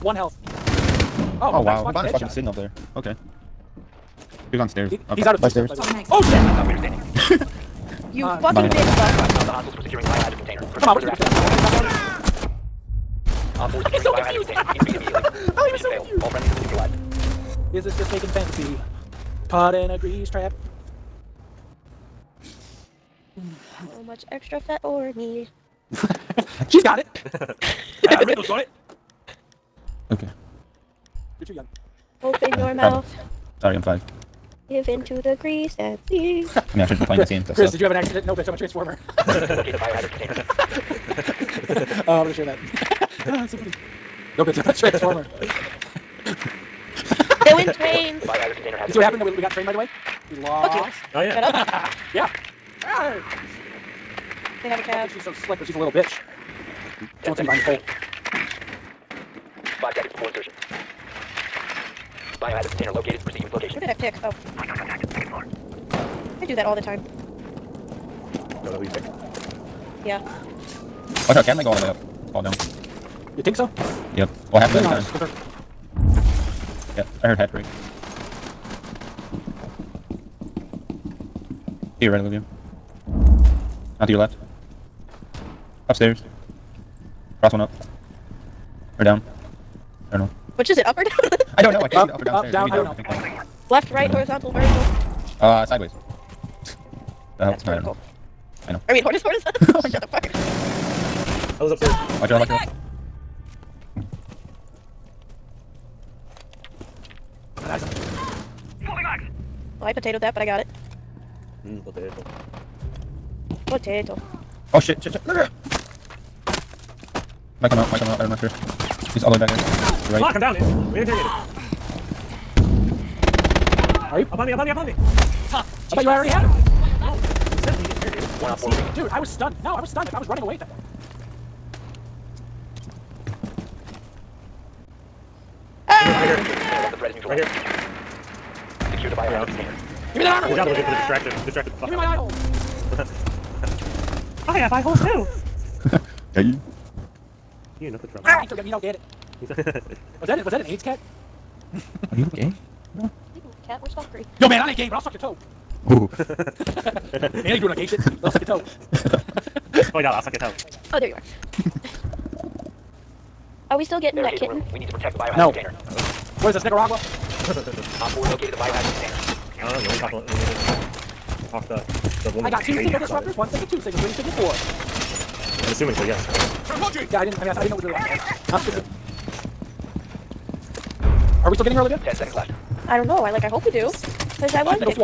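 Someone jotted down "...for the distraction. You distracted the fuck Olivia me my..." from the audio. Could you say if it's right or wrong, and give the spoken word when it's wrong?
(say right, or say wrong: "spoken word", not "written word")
wrong: "Give", not "Olivia".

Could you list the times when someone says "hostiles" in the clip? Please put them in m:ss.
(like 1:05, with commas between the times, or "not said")
0:09, 1:04.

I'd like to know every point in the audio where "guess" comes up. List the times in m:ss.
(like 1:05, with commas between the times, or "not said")
not said.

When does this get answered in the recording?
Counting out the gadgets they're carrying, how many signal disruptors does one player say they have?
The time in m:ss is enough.
2:52.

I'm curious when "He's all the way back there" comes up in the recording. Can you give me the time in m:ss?
1:59.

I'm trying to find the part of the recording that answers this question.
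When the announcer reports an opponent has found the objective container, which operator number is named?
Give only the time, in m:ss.
2:47.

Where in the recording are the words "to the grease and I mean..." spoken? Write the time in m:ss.
0:35.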